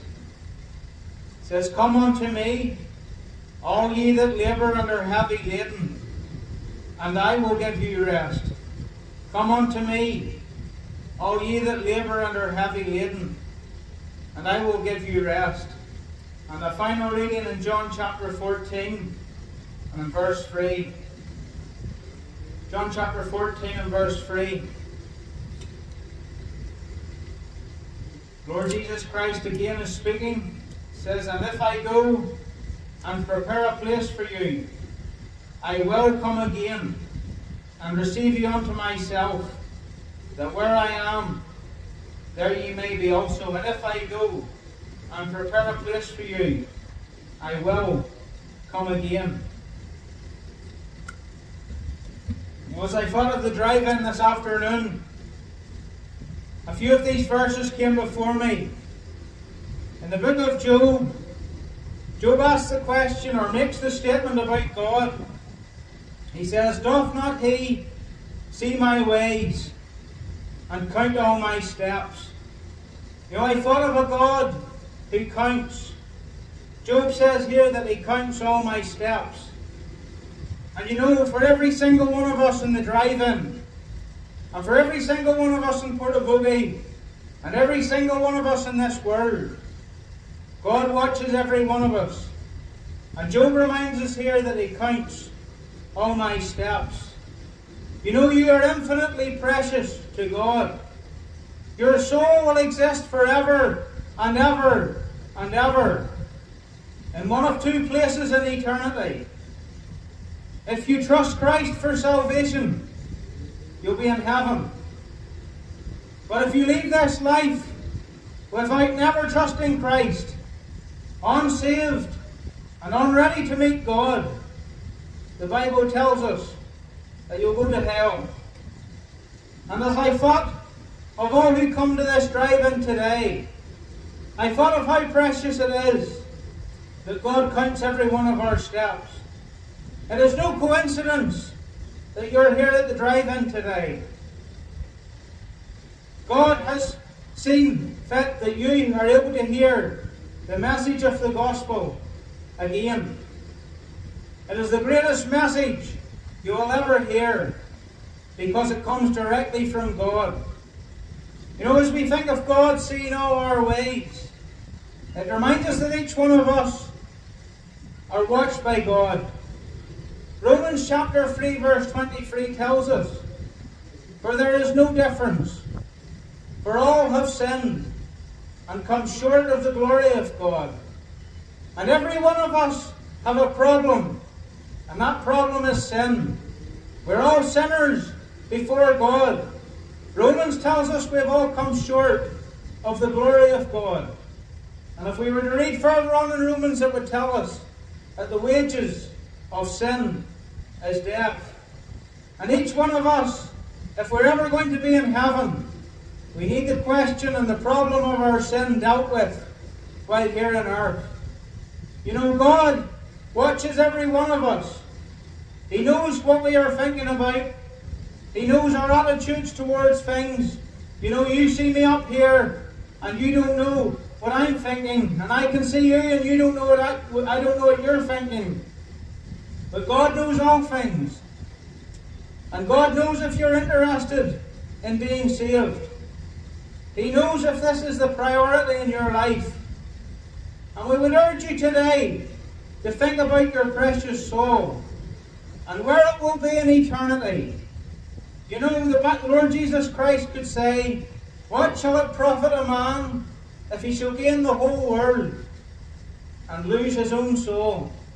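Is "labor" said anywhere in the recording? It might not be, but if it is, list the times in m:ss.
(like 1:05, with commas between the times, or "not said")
0:04, 0:11.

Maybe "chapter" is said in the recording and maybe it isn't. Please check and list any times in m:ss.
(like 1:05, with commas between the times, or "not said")
0:17, 0:22, 2:50.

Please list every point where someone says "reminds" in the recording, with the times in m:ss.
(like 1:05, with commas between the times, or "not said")
1:33, 2:45.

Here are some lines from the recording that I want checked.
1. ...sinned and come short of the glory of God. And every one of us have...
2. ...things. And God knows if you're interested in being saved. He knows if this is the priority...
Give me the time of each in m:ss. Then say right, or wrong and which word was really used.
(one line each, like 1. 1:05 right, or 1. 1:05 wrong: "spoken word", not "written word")
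1. 2:57 right
2. 3:50 right.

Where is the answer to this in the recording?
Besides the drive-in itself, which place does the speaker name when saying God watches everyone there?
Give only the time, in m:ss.
1:25.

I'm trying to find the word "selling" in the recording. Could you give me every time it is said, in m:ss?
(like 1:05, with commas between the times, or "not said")
not said.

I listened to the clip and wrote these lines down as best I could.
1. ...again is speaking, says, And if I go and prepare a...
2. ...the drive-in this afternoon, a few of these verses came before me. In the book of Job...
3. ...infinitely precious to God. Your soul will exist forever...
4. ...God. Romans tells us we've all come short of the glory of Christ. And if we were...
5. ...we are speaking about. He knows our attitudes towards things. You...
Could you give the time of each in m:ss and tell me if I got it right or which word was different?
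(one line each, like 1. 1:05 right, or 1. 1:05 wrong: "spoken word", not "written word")
1. 0:29 right
2. 0:53 right
3. 1:38 right
4. 3:08 wrong: "God", not "Christ"
5. 3:36 wrong: "thinking", not "speaking".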